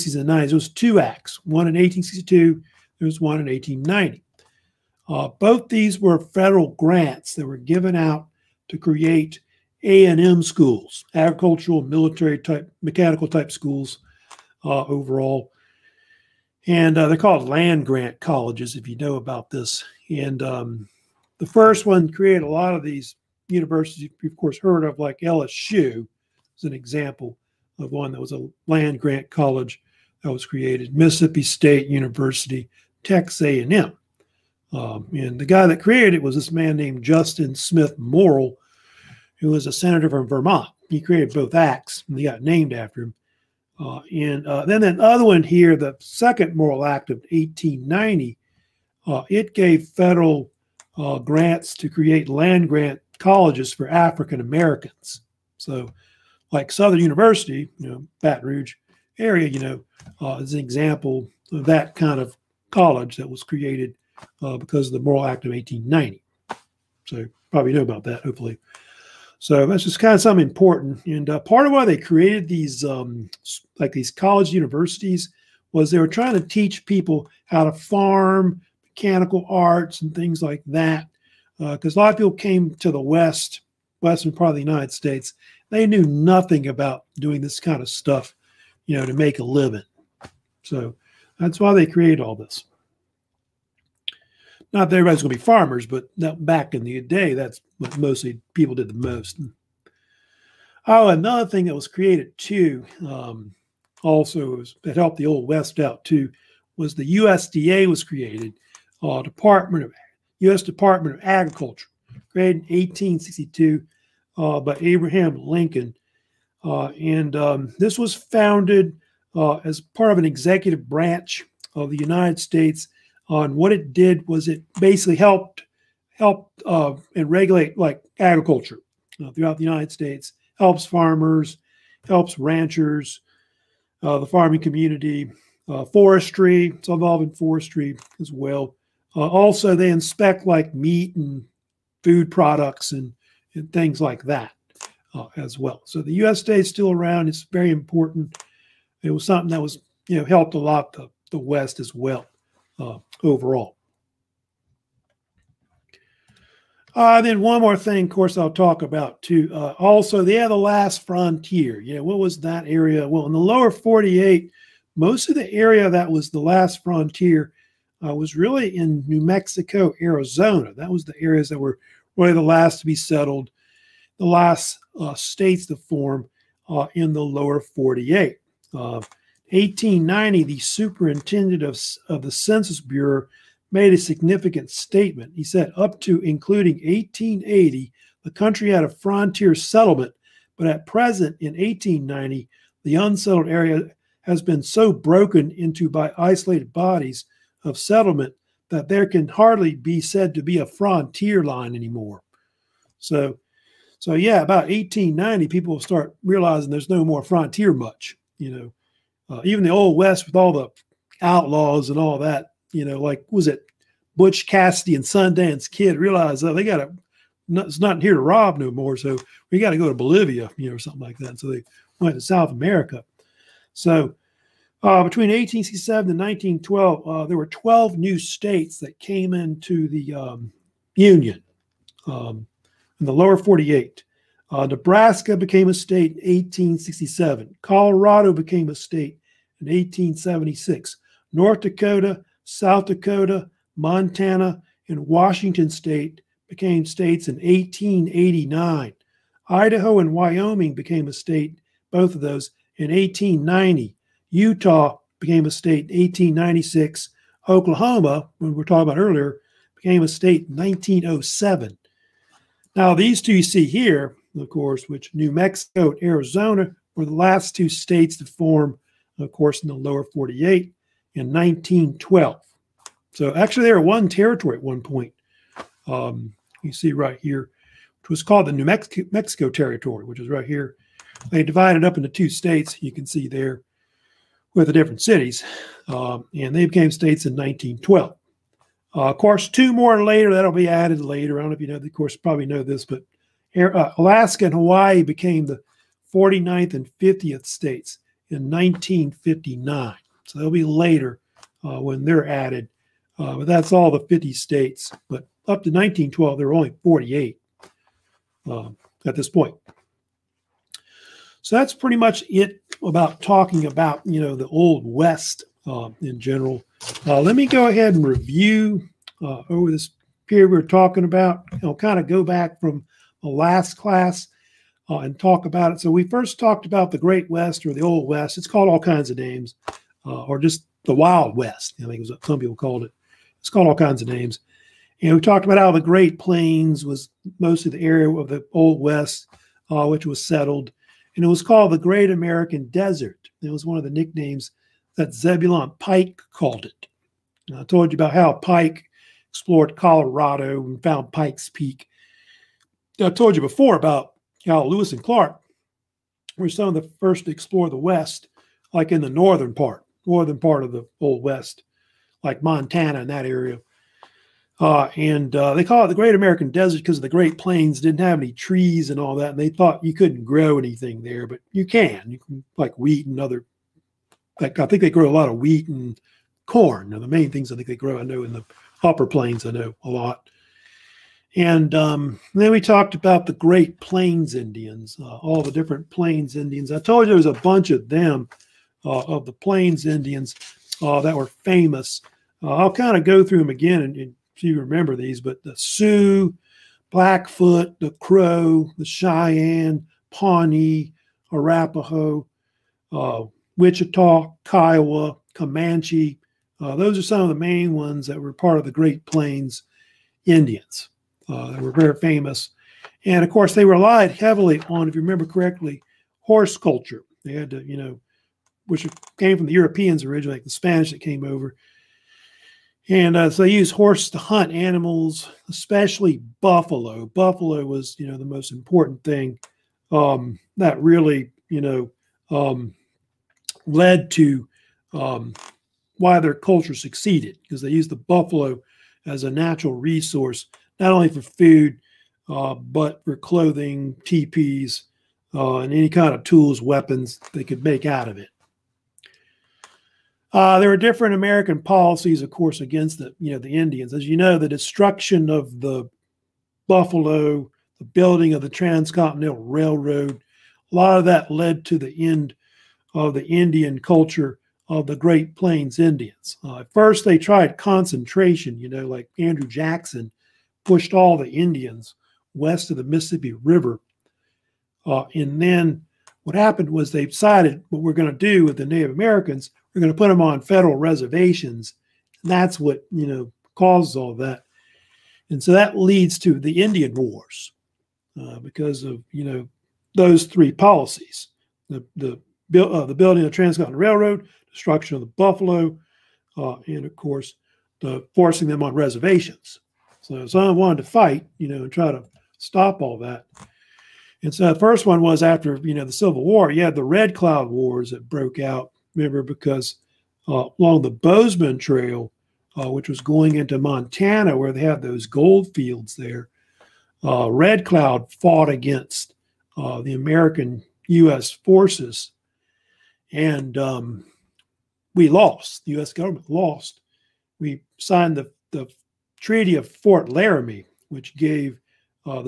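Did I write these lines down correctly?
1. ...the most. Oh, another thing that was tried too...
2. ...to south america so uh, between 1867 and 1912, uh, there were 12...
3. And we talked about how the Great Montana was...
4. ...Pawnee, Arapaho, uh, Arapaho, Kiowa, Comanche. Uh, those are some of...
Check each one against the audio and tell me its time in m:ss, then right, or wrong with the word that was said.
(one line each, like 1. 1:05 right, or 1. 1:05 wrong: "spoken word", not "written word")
1. 1:38 wrong: "created", not "tried"
2. 3:42 right
3. 5:35 wrong: "Plains", not "Montana"
4. 6:40 wrong: "Wichita", not "Arapaho".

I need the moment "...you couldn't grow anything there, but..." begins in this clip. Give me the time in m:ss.
6:09.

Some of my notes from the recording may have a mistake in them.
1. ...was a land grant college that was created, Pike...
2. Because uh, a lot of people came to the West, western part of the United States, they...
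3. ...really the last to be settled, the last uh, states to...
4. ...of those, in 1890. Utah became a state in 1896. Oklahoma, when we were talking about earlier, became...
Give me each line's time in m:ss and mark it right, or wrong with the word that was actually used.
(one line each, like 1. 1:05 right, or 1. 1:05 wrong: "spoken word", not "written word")
1. 0:28 wrong: "Mississippi", not "Pike"
2. 1:21 right
3. 2:52 right
4. 4:12 right.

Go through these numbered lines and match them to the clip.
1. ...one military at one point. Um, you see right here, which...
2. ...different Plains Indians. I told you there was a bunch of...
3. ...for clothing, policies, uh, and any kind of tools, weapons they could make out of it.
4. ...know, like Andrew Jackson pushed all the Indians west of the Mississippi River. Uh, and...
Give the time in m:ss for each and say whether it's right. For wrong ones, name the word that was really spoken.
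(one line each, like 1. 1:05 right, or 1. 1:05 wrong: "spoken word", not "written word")
1. 4:33 wrong: "territory", not "military"
2. 6:25 right
3. 7:23 wrong: "teepees", not "policies"
4. 7:48 right.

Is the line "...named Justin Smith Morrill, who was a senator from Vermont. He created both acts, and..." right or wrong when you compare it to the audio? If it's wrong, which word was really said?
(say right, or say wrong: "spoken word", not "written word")
right.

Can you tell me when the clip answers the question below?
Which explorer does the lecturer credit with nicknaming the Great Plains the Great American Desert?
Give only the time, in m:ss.
5:45.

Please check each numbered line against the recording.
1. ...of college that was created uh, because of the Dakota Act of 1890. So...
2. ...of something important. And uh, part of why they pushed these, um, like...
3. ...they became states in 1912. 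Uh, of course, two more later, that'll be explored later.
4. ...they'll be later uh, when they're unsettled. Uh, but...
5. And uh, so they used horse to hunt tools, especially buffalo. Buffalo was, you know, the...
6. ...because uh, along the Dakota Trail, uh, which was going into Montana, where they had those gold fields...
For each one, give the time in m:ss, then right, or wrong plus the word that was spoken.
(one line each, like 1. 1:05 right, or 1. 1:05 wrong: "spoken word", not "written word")
1. 1:02 wrong: "Morrill", not "Dakota"
2. 1:10 wrong: "created", not "pushed"
3. 4:46 wrong: "added", not "explored"
4. 5:00 wrong: "added", not "unsettled"
5. 7:02 wrong: "animals", not "tools"
6. 8:29 wrong: "Bozeman", not "Dakota".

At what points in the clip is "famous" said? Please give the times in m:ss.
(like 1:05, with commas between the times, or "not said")
6:31, 6:51.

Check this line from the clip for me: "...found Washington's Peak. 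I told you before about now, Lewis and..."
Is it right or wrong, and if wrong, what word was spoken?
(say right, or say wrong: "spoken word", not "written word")
wrong: "Pike", not "Washington".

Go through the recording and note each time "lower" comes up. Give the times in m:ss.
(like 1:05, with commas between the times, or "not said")
2:43, 2:57, 3:53, 4:29.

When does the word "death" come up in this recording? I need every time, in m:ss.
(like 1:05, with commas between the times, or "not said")
not said.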